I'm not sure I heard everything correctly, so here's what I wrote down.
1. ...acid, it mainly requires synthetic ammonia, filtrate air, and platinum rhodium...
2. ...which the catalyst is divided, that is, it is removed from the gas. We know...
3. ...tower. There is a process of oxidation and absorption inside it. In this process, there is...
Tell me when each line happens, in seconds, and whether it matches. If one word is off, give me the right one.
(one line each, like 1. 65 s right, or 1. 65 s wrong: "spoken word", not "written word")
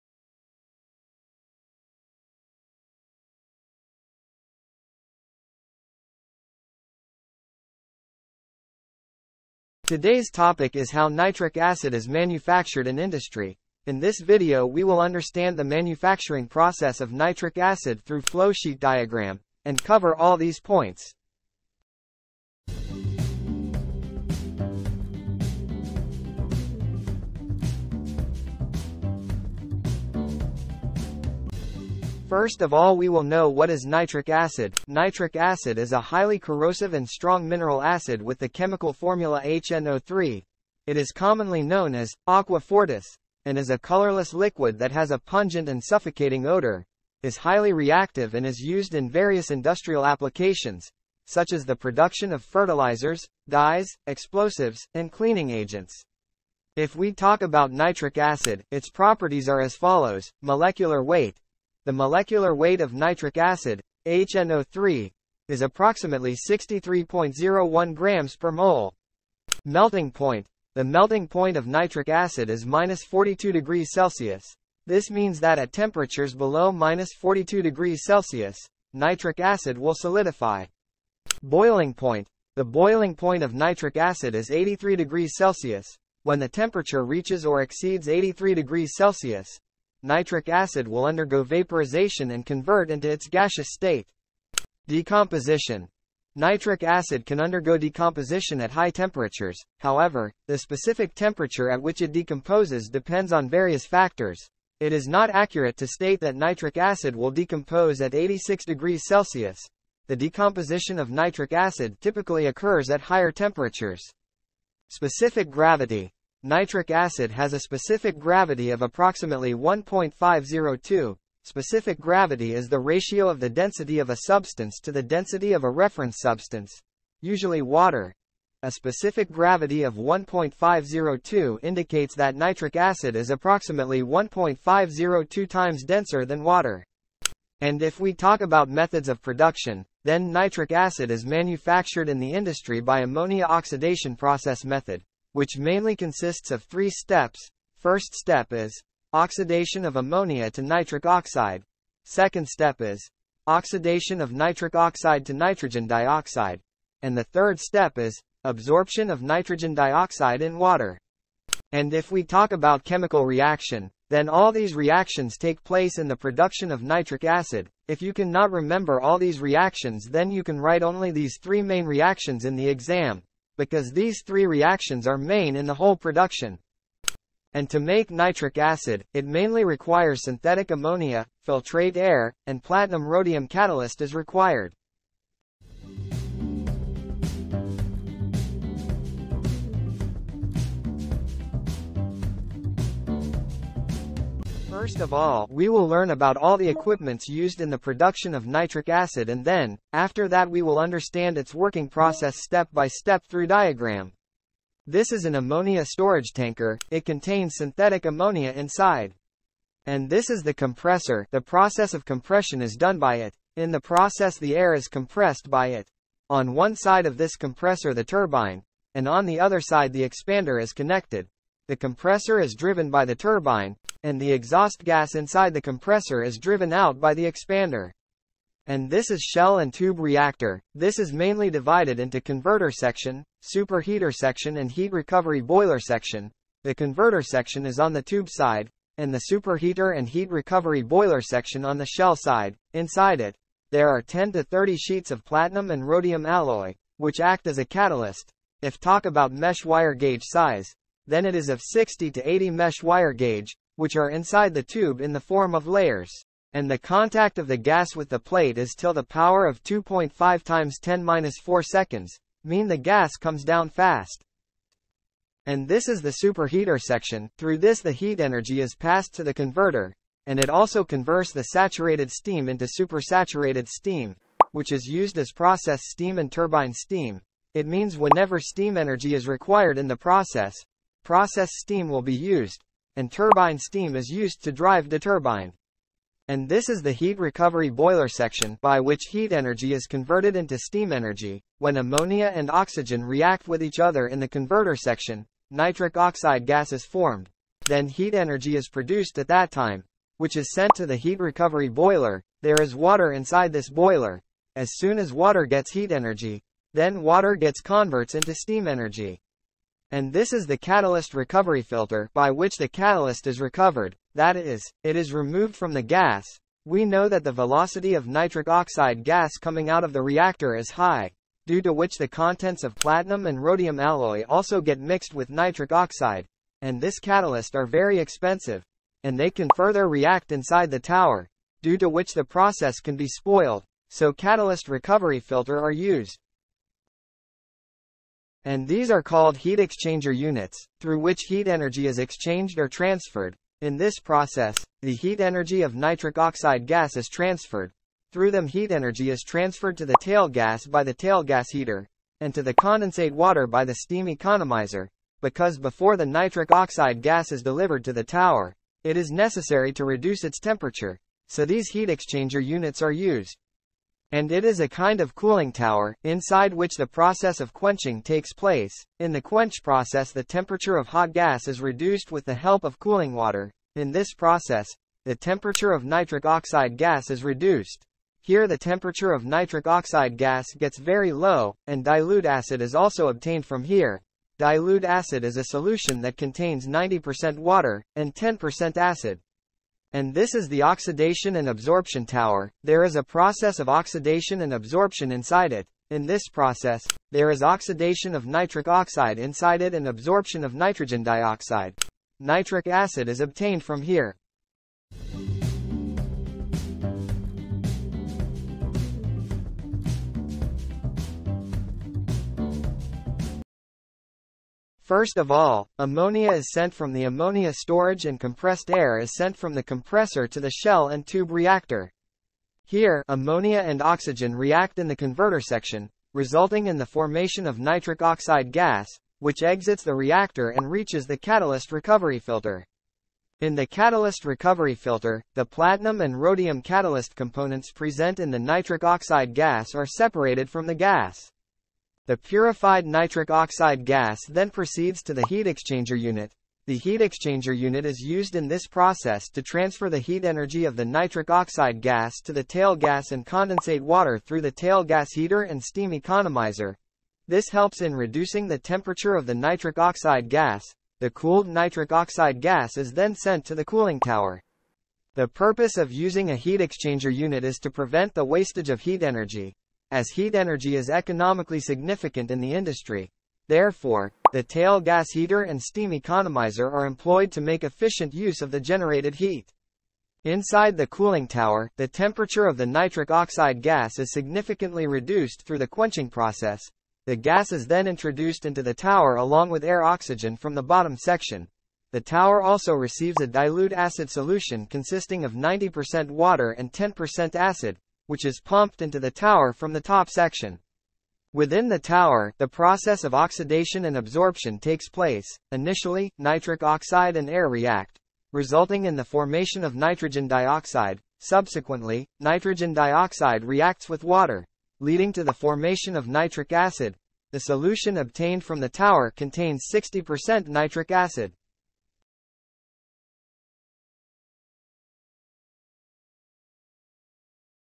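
1. 178 s right
2. 312 s wrong: "recovered", not "divided"
3. 392 s right.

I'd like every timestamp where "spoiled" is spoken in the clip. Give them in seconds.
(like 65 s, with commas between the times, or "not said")
333 s.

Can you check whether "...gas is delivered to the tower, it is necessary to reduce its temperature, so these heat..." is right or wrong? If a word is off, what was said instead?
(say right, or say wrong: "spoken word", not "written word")
right.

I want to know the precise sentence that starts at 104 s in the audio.
It is not accurate to state that nitric acid will decompose at 86 degrees Celsius.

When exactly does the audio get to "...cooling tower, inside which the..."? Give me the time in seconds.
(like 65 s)
365 s.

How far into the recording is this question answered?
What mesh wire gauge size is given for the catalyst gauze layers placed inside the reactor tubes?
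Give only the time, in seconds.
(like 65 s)
251 s.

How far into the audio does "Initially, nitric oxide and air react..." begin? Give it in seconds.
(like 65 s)
505 s.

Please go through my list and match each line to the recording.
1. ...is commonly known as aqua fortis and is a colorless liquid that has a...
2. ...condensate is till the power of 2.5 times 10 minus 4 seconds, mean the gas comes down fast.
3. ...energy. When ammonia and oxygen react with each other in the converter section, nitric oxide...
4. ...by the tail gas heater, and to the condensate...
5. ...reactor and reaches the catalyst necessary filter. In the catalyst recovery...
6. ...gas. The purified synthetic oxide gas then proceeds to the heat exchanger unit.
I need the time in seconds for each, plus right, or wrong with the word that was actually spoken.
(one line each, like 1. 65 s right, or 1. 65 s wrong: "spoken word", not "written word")
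1. 40 s right
2. 258 s wrong: "plate", not "condensate"
3. 290 s right
4. 350 s right
5. 429 s wrong: "recovery", not "necessary"
6. 440 s wrong: "nitric", not "synthetic".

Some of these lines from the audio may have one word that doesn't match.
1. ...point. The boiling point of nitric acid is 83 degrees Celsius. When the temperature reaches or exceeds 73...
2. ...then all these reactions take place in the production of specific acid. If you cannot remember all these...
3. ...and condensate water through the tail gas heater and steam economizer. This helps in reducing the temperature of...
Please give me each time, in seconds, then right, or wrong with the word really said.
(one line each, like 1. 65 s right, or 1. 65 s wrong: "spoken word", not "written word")
1. 81 s wrong: "83", not "73"
2. 164 s wrong: "nitric", not "specific"
3. 453 s right.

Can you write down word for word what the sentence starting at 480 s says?
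Inside the cooling tower, the temperature of the nitric oxide gas is significantly reduced through the quenching process.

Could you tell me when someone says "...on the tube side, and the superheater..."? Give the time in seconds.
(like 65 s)
237 s.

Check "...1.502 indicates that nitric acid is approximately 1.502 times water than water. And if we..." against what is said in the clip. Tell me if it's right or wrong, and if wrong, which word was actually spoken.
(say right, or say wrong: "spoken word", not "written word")
wrong: "denser", not "water".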